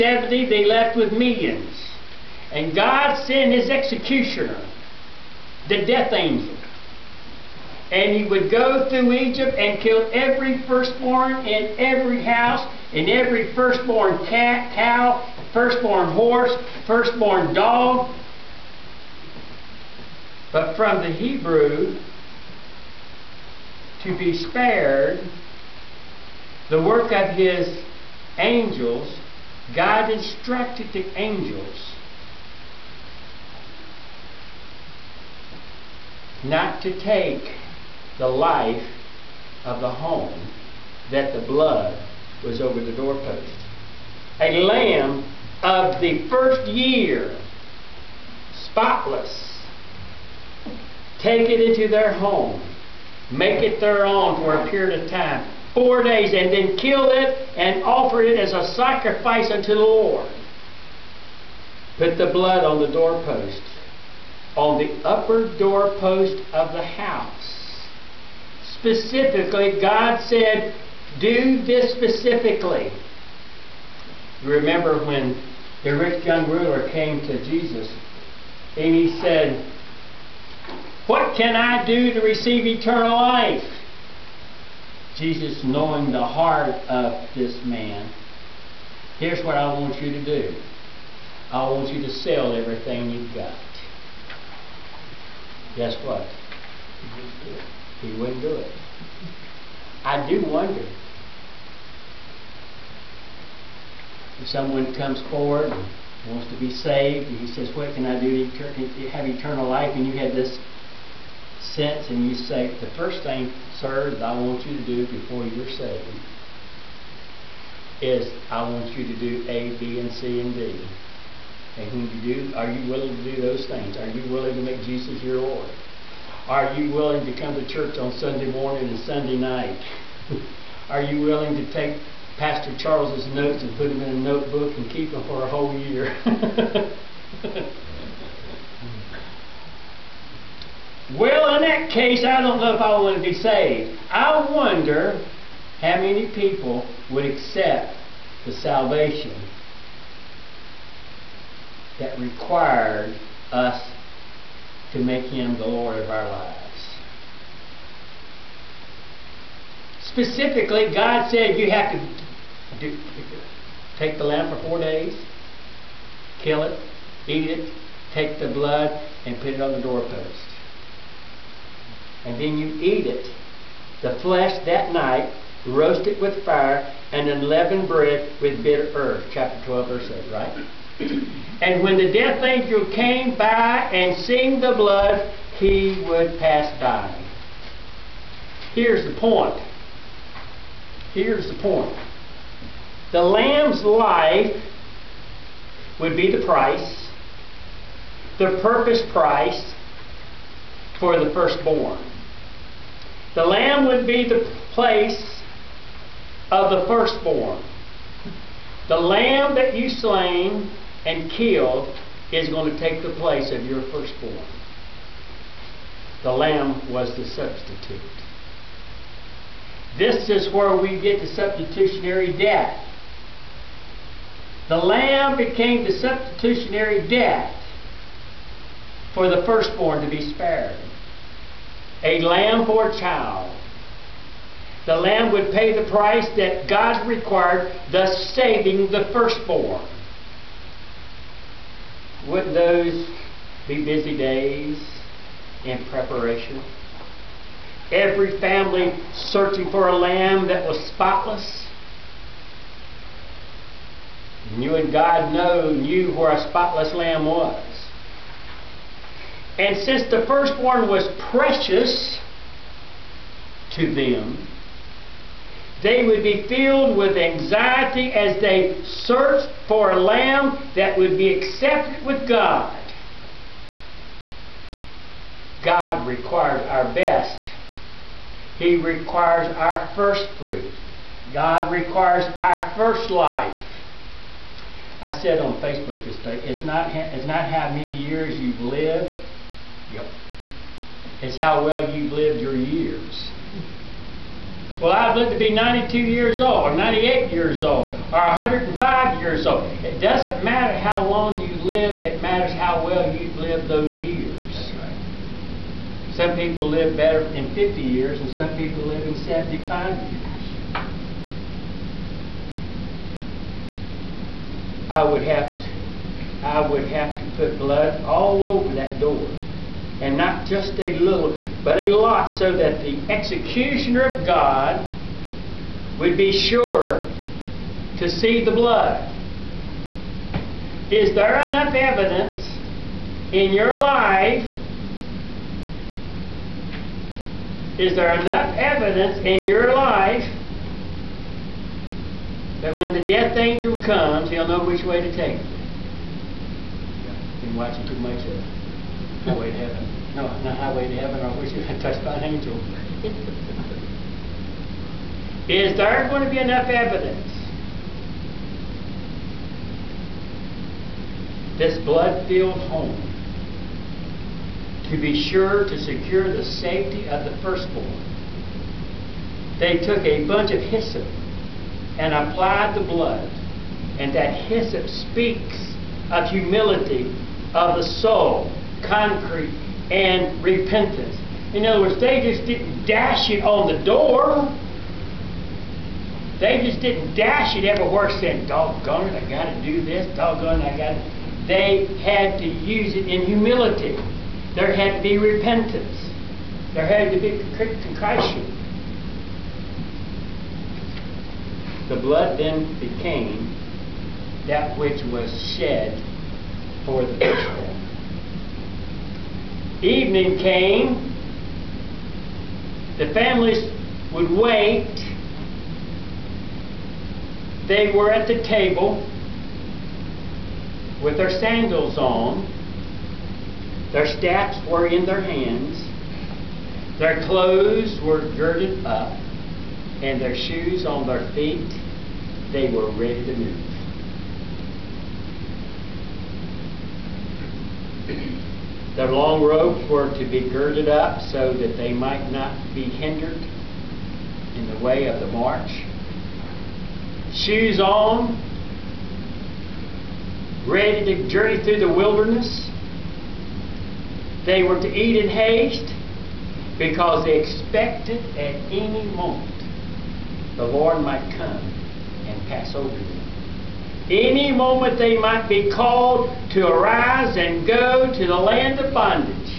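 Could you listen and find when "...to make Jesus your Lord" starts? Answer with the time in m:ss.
2:04.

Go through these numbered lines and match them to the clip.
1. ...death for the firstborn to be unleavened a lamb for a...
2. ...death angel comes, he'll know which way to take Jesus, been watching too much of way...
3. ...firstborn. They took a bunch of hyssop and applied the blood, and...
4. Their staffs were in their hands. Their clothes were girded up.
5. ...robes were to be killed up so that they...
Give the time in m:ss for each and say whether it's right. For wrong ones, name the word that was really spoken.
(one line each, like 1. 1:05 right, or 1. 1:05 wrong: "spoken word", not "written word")
1. 3:47 wrong: "spared", not "unleavened"
2. 5:43 wrong: "Yeah", not "Jesus"
3. 6:07 right
4. 7:03 right
5. 7:19 wrong: "girded", not "killed".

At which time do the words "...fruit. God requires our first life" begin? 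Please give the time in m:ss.
4:40.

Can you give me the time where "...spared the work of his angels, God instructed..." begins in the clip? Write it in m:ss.
0:24.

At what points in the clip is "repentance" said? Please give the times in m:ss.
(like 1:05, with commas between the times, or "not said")
6:20, 6:35.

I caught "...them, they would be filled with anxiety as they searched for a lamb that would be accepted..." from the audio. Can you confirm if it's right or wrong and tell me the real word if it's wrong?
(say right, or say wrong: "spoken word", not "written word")
right.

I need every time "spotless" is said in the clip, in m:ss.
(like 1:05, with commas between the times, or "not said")
0:48, 4:10, 4:16.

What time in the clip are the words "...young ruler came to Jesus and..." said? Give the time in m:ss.
1:16.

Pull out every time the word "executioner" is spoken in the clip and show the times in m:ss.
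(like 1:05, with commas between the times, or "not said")
0:03, 5:23.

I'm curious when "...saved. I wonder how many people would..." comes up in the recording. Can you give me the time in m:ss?
2:23.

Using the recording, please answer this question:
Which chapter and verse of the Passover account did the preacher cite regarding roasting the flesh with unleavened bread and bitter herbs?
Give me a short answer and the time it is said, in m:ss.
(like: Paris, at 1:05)
Chapter 12, verse 8, at 2:59.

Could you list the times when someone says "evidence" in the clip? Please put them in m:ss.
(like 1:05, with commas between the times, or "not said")
5:31, 5:38, 5:56.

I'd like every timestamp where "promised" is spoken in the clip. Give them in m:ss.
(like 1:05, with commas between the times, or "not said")
not said.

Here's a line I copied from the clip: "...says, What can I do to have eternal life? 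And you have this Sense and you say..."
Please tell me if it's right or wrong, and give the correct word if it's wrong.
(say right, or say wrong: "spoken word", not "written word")
right.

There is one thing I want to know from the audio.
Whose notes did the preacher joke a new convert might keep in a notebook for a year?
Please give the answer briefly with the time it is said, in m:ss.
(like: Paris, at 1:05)
Pastor Charles, at 2:12.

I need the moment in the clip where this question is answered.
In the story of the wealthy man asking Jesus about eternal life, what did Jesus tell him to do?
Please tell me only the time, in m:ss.
1:32.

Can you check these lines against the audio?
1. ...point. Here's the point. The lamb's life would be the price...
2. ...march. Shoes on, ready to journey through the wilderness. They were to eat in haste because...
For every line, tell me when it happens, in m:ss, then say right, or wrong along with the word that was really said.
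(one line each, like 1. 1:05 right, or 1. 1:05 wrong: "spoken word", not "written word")
1. 3:09 right
2. 7:25 right.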